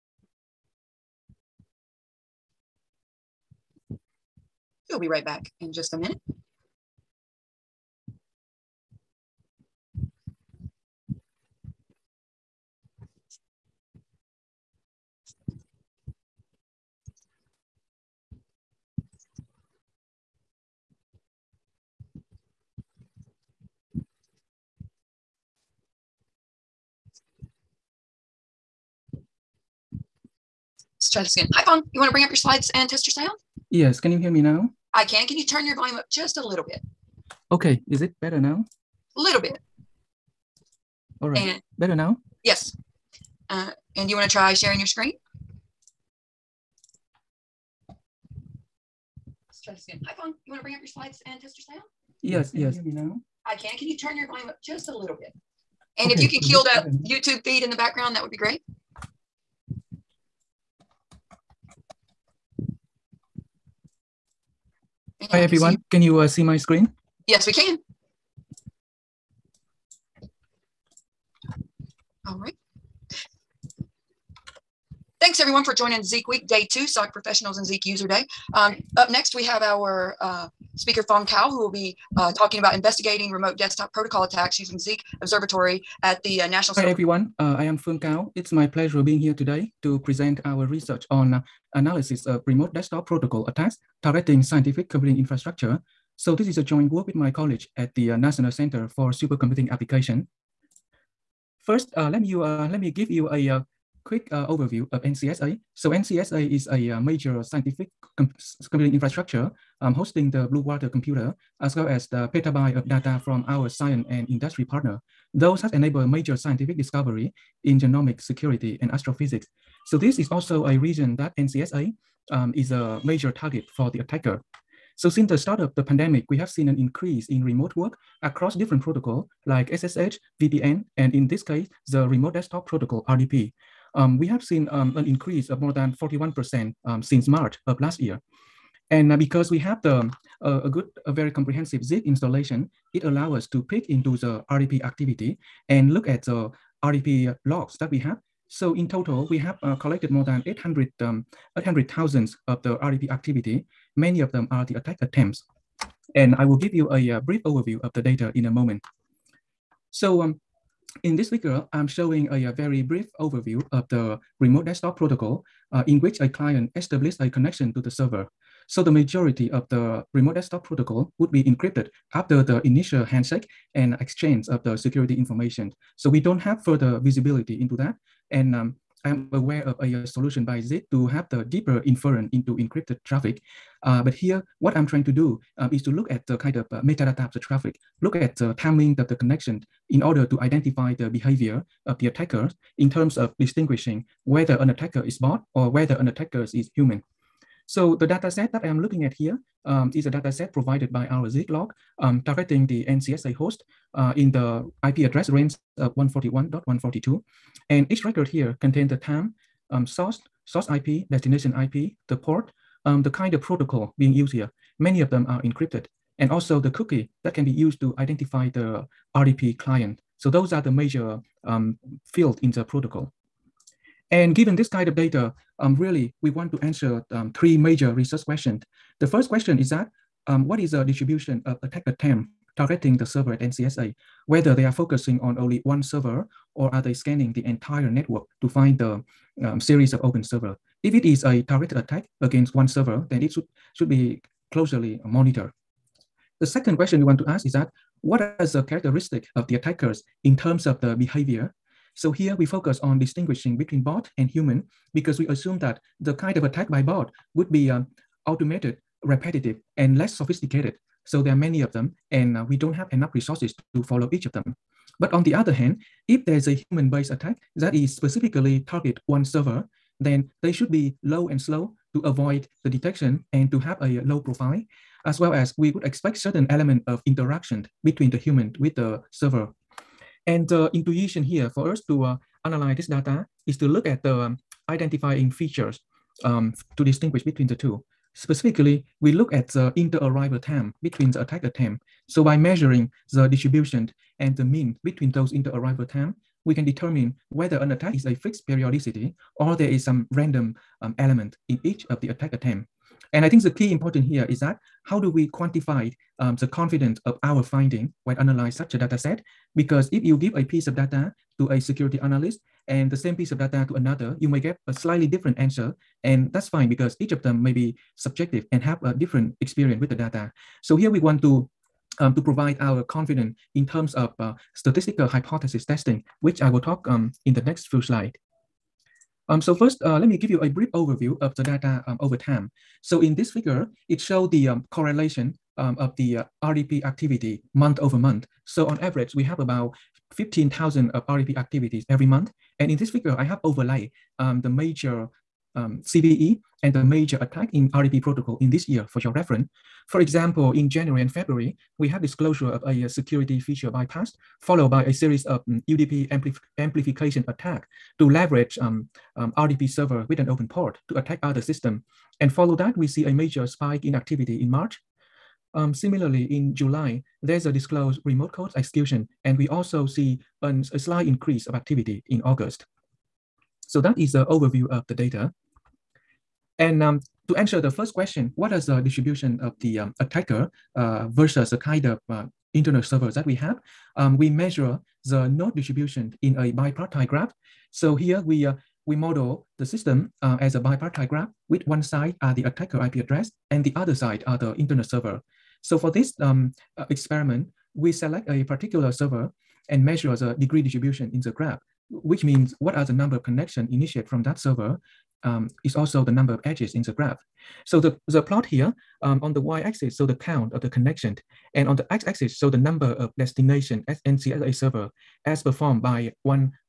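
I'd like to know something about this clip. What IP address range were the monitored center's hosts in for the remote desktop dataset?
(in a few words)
141.142.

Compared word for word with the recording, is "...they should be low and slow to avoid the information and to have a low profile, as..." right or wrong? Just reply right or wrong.
wrong.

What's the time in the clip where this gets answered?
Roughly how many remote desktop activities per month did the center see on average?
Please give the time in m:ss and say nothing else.
5:40.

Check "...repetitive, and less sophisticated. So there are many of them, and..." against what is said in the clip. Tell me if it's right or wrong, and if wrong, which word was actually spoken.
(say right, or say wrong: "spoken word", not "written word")
right.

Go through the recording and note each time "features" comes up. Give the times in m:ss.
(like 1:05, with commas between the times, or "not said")
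4:45, 5:53.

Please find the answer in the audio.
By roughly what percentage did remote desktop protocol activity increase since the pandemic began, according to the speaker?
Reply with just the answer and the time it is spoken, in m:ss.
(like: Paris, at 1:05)
41%, at 2:15.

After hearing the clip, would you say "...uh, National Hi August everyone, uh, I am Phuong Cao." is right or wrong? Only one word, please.
wrong.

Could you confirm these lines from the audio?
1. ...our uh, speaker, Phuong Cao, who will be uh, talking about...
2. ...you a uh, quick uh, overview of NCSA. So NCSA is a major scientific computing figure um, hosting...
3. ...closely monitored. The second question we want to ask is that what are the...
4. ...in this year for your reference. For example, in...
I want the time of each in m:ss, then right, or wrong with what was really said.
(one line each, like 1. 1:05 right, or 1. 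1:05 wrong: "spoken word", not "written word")
1. 1:19 right
2. 1:43 wrong: "infrastructure", not "figure"
3. 4:04 right
4. 5:48 right.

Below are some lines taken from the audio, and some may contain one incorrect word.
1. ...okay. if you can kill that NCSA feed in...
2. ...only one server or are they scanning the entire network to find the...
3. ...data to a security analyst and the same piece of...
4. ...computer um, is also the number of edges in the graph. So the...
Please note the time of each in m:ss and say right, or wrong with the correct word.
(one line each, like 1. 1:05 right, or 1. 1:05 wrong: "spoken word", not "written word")
1. 0:56 wrong: "YouTube", not "NCSA"
2. 3:55 right
3. 5:10 right
4. 6:44 wrong: "server", not "computer".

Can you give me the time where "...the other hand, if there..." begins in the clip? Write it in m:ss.
4:25.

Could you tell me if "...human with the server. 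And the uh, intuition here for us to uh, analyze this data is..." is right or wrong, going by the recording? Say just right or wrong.
right.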